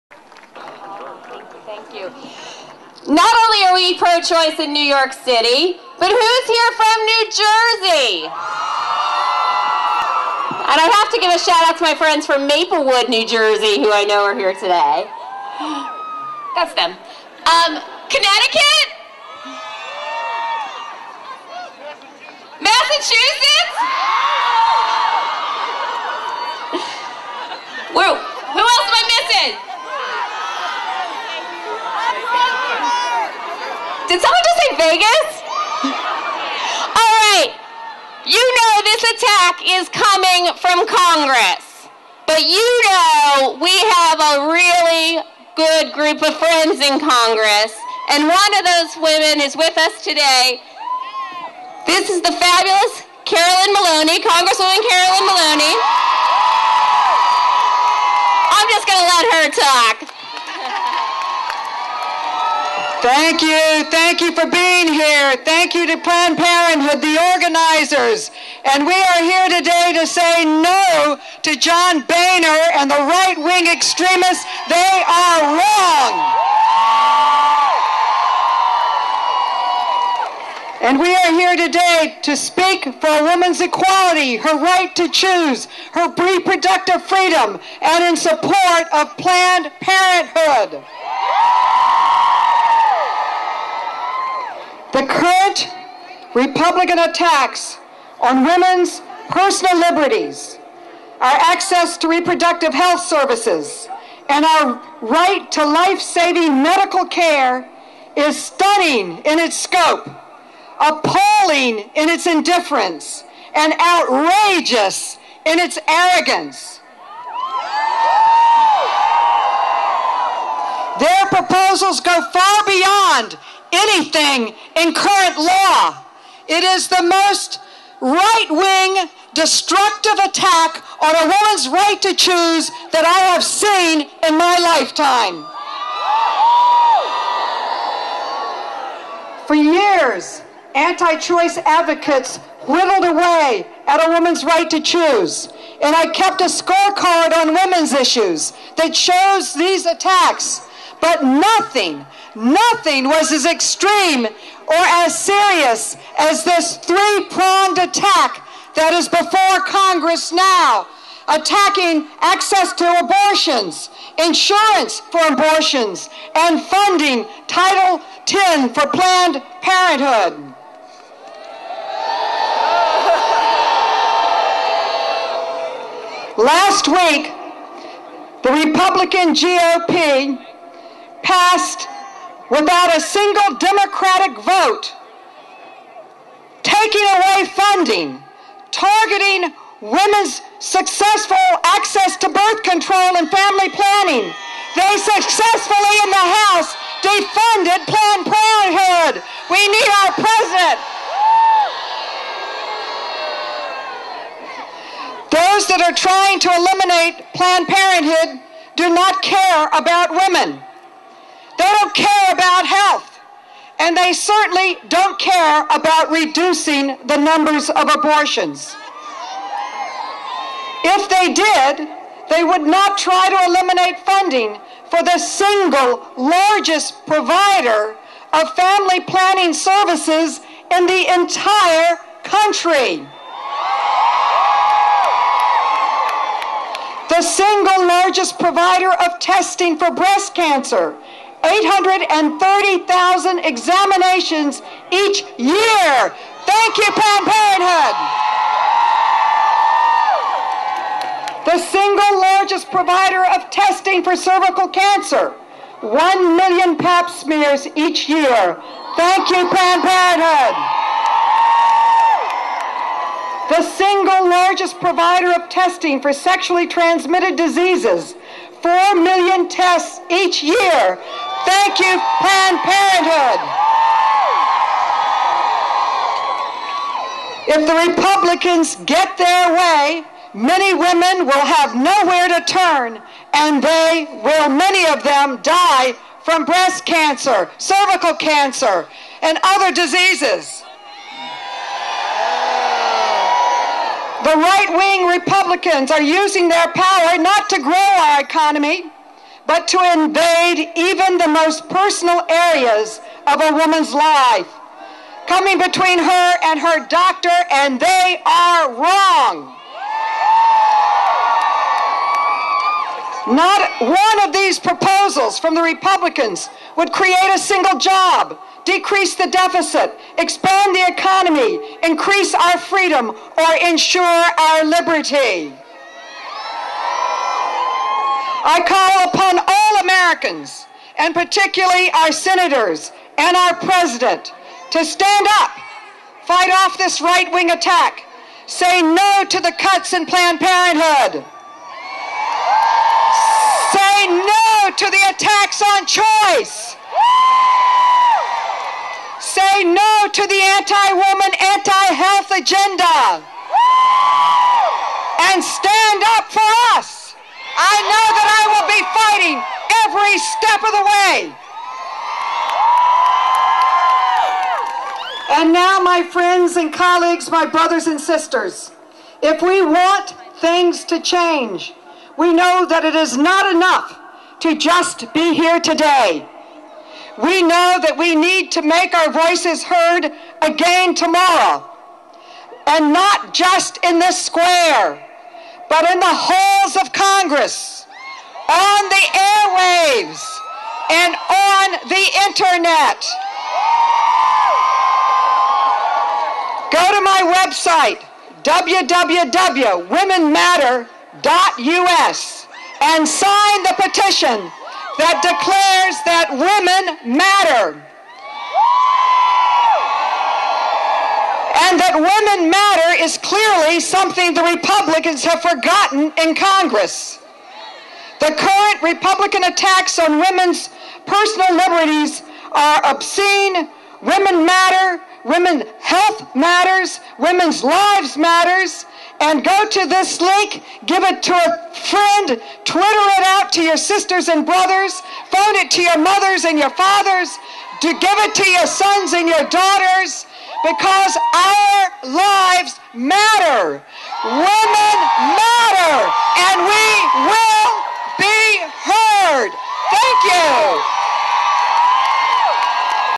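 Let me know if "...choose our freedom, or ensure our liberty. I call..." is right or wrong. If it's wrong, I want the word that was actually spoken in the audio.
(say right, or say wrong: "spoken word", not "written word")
wrong: "increase", not "choose".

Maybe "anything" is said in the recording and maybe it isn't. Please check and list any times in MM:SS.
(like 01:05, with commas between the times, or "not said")
02:03.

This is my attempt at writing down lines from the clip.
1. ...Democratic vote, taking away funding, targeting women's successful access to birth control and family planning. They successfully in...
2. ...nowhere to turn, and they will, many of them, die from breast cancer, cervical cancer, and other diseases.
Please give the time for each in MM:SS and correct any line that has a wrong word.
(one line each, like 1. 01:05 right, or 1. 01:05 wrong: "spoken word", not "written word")
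1. 03:03 right
2. 04:41 right.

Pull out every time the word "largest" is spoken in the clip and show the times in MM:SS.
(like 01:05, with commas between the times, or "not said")
03:46, 03:57, 04:12, 04:24.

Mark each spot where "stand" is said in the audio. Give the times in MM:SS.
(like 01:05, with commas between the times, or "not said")
05:34, 05:55.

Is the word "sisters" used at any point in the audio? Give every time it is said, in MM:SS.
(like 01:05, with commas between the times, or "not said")
06:07, 07:13.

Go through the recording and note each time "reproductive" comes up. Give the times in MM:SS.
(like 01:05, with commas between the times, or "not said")
01:26, 01:42.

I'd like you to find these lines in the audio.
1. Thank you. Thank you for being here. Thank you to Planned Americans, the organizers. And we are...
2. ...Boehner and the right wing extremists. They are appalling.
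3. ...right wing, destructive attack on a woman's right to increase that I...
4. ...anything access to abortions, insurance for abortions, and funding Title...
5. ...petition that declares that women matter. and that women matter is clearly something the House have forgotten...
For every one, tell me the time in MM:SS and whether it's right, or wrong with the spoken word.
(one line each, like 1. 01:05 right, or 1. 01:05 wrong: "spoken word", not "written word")
1. 01:03 wrong: "Parenthood", not "Americans"
2. 01:12 wrong: "wrong", not "appalling"
3. 02:08 wrong: "choose", not "increase"
4. 02:41 wrong: "attacking", not "anything"
5. 06:43 wrong: "Republicans", not "House".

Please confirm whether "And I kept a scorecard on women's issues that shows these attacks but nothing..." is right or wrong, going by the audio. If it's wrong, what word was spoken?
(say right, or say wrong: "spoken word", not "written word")
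right.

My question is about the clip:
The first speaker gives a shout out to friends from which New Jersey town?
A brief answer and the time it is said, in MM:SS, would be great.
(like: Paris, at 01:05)
Maplewood, at 00:12.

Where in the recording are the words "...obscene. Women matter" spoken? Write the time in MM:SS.
07:02.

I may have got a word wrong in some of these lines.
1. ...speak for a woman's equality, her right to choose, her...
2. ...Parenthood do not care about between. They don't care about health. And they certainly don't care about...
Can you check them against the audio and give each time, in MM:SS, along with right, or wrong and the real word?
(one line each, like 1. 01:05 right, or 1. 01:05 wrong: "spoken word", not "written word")
1. 01:22 right
2. 03:27 wrong: "women", not "between".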